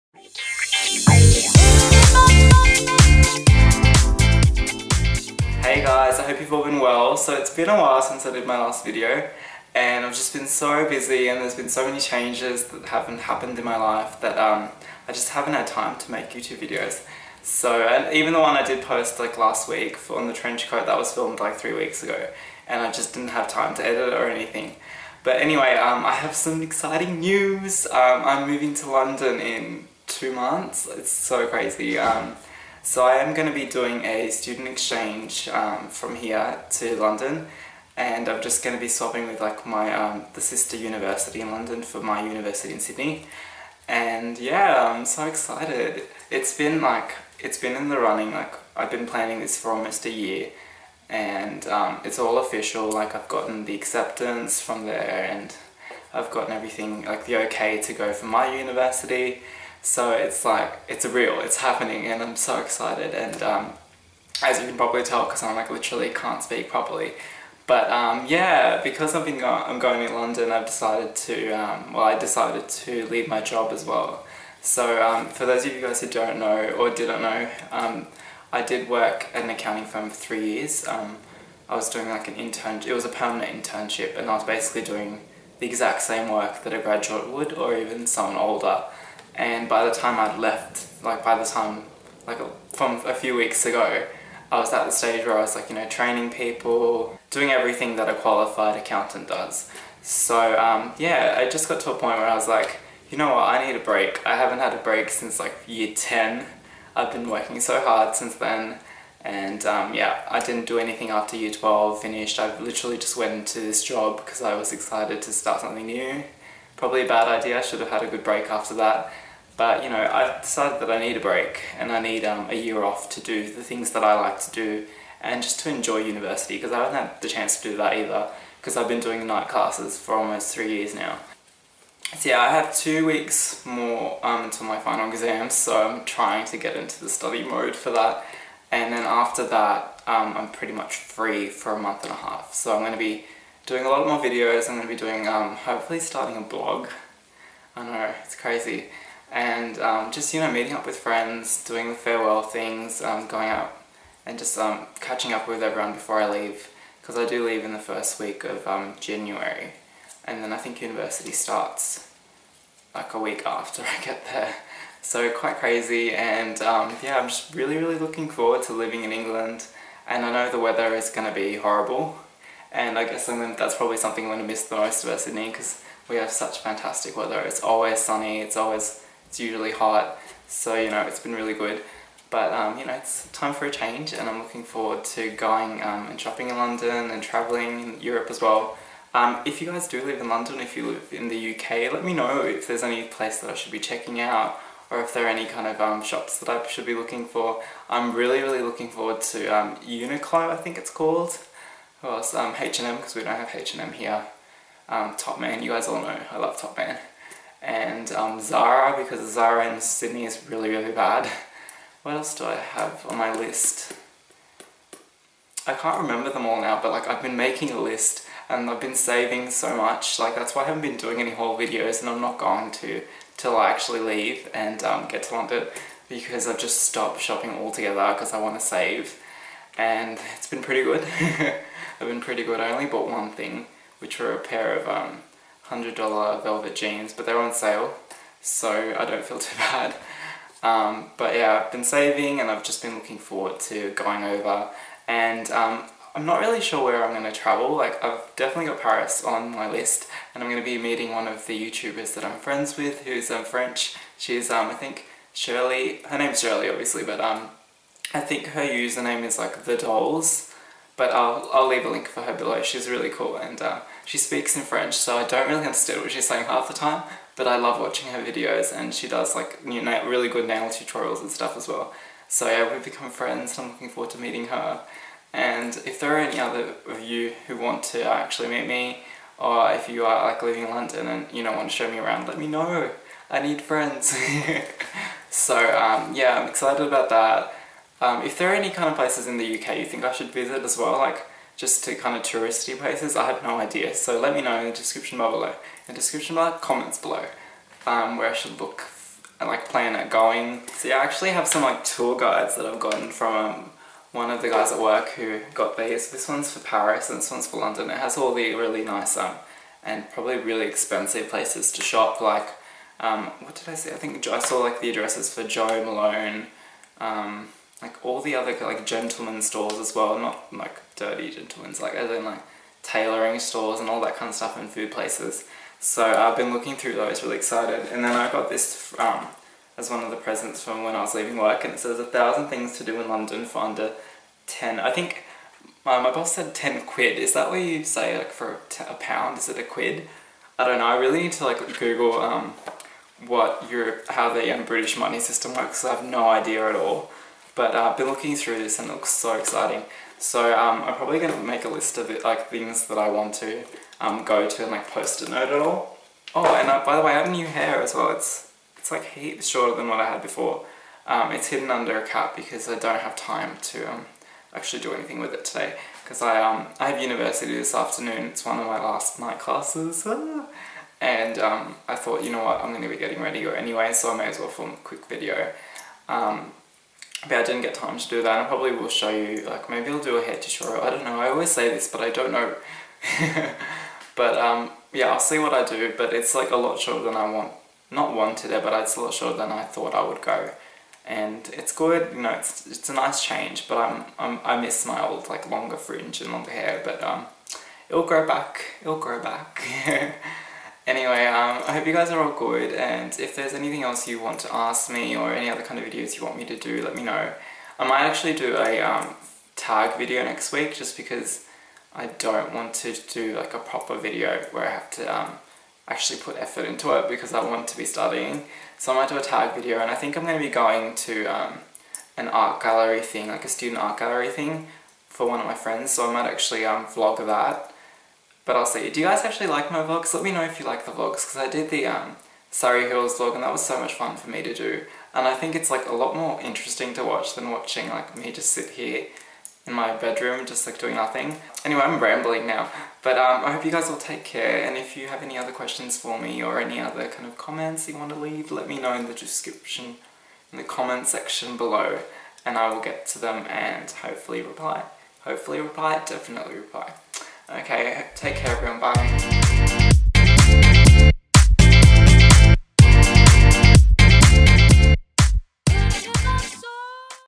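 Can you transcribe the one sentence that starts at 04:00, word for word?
Um, but yeah, I've been saving and I've just been looking forward to going over.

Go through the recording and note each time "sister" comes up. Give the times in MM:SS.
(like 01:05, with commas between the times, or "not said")
00:40.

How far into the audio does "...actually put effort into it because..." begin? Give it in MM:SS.
06:55.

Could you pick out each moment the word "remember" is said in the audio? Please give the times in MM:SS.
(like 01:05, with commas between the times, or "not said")
03:36.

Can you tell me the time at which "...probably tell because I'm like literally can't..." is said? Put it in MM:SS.
01:04.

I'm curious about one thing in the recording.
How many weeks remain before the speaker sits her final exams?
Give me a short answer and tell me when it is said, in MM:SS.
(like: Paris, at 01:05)
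2 weeks, at 02:12.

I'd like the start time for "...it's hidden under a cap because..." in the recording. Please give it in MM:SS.
06:01.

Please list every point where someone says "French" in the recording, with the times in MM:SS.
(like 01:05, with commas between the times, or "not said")
04:13, 04:24.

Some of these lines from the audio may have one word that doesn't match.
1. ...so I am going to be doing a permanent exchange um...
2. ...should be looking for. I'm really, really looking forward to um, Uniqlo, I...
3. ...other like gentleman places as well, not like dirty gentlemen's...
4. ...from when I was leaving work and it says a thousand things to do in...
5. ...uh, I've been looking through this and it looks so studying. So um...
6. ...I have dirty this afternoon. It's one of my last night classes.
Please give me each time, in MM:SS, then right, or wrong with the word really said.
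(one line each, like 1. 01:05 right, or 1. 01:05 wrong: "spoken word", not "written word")
1. 00:32 wrong: "student", not "permanent"
2. 03:16 right
3. 05:18 wrong: "stores", not "places"
4. 05:30 right
5. 05:47 wrong: "exciting", not "studying"
6. 06:06 wrong: "university", not "dirty".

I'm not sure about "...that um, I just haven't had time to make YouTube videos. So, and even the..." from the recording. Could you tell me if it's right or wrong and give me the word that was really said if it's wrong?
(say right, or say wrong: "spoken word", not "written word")
right.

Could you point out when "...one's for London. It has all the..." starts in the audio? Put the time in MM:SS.
05:07.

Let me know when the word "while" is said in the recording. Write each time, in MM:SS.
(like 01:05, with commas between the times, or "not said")
00:07.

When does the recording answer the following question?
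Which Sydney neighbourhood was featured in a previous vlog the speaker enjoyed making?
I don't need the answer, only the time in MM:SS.
07:12.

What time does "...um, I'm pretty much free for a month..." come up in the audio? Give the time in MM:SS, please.
02:20.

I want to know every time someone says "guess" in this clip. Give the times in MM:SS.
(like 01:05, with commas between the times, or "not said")
02:53.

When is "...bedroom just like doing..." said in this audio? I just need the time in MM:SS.
07:19.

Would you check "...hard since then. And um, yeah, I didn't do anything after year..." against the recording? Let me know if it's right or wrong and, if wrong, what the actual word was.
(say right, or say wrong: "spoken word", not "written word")
right.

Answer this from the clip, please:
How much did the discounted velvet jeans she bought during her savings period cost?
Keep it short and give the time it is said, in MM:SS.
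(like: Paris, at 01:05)
$100, at 03:55.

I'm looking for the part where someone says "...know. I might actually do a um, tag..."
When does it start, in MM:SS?
06:47.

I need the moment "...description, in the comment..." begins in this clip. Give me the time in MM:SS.
07:29.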